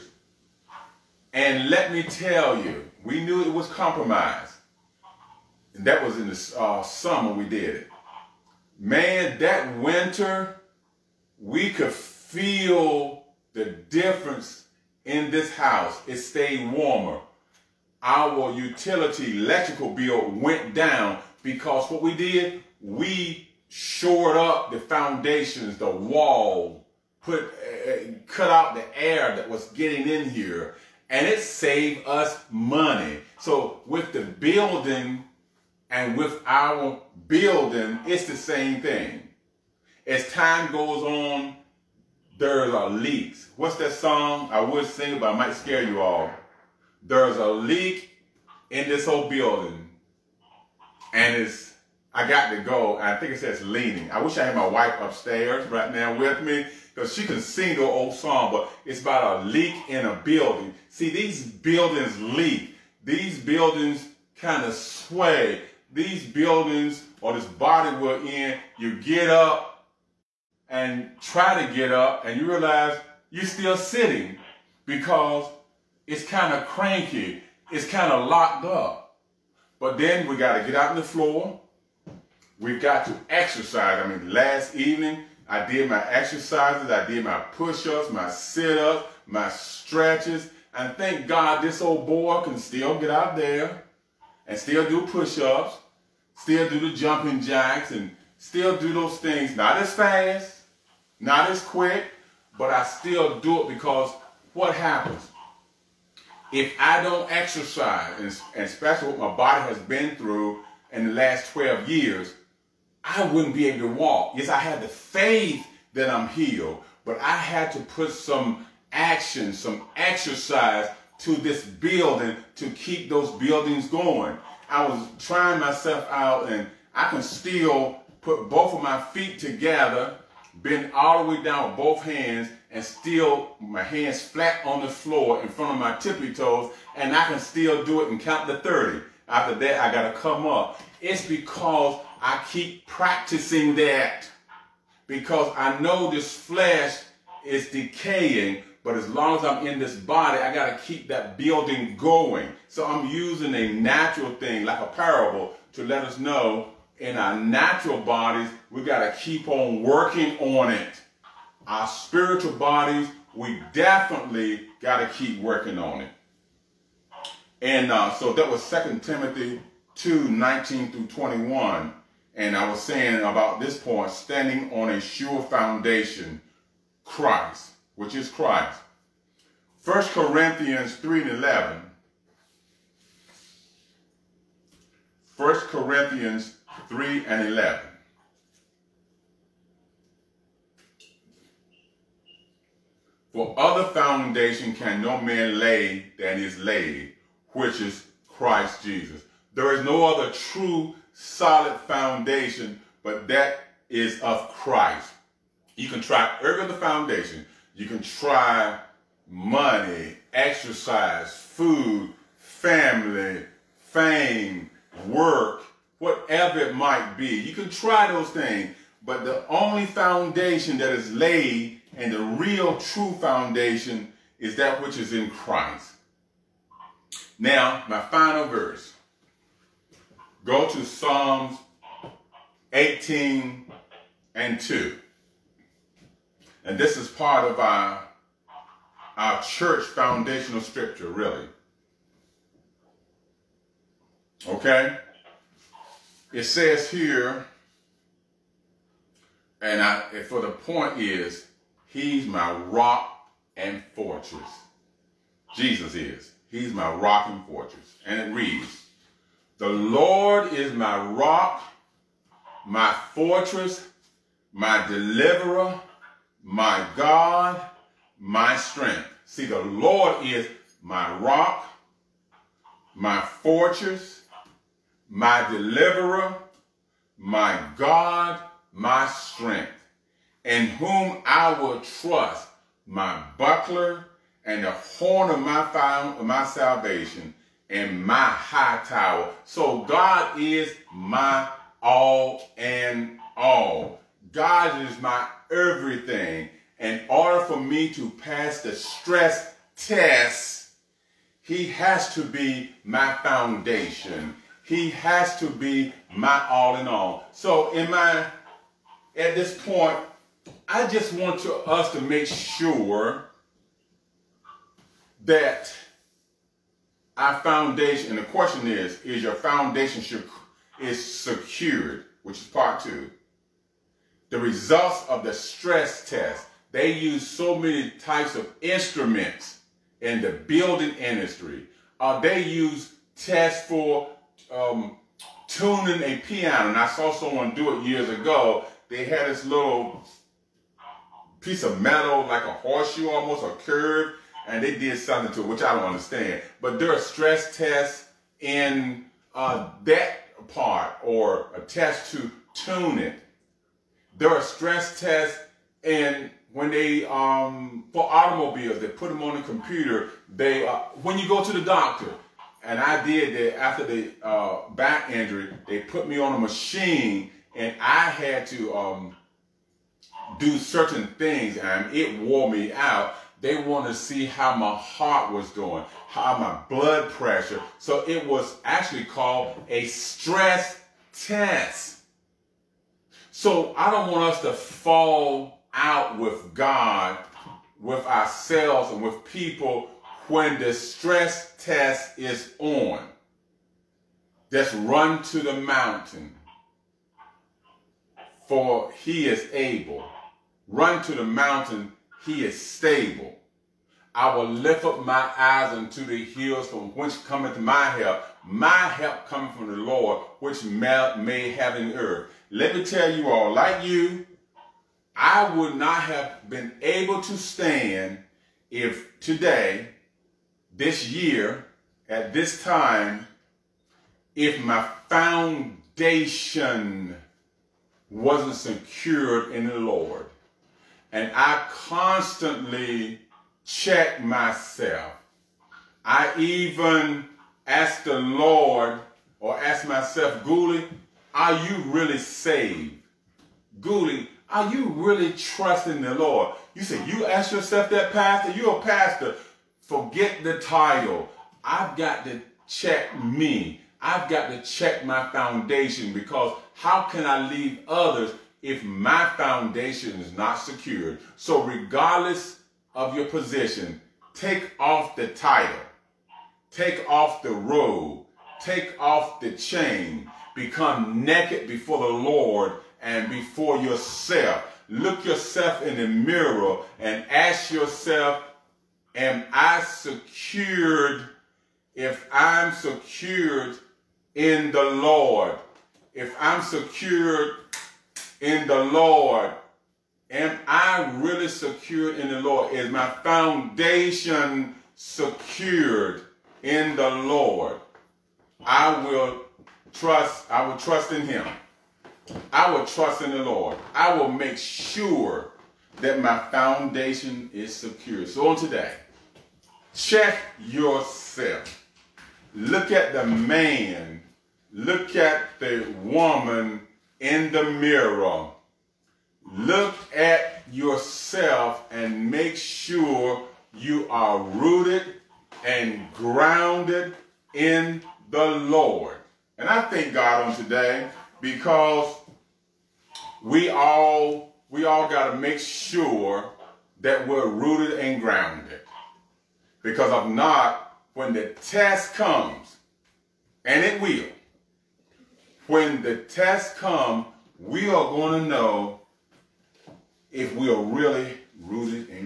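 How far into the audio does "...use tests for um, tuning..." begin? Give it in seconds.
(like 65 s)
332 s.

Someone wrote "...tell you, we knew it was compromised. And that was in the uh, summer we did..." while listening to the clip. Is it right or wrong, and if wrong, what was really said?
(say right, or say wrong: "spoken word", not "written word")
right.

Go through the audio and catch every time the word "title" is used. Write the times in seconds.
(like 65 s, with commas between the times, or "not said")
450 s, 465 s.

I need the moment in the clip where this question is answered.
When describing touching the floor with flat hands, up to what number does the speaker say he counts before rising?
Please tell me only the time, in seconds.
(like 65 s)
138 s.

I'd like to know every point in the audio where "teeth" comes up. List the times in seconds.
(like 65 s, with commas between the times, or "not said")
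not said.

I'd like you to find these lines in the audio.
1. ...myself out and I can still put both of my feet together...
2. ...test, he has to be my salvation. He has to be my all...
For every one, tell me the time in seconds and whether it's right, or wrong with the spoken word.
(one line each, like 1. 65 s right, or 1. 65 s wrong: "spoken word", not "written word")
1. 125 s right
2. 299 s wrong: "foundation", not "salvation".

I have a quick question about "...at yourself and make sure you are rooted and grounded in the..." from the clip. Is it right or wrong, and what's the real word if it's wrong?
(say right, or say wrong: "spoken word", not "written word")
right.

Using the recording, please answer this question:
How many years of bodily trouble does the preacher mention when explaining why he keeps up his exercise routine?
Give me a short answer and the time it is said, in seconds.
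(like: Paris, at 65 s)
12, at 111 s.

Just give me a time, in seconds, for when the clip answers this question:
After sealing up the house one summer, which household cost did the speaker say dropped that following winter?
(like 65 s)
19 s.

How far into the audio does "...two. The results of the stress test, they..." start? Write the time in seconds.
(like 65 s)
322 s.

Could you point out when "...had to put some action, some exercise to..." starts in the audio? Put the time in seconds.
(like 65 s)
117 s.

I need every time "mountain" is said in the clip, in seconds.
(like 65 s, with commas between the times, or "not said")
395 s, 401 s.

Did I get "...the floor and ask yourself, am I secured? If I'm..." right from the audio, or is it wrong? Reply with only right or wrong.
wrong.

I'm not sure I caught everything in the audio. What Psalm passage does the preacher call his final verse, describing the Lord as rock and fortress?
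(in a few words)
Psalms 18:2.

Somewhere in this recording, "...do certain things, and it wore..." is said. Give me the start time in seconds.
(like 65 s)
370 s.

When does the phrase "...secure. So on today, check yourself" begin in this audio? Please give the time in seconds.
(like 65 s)
507 s.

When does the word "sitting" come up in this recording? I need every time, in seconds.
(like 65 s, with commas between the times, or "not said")
73 s.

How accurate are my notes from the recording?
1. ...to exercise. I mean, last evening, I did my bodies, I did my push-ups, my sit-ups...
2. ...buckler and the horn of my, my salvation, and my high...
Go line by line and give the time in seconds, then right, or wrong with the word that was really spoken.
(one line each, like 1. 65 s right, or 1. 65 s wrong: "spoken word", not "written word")
1. 83 s wrong: "exercises", not "bodies"
2. 283 s right.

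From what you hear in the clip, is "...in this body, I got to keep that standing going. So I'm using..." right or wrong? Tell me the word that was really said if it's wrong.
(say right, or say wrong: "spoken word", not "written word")
wrong: "building", not "standing".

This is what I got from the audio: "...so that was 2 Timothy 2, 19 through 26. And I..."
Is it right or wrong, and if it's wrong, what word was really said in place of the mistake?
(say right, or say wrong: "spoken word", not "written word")
wrong: "21", not "26".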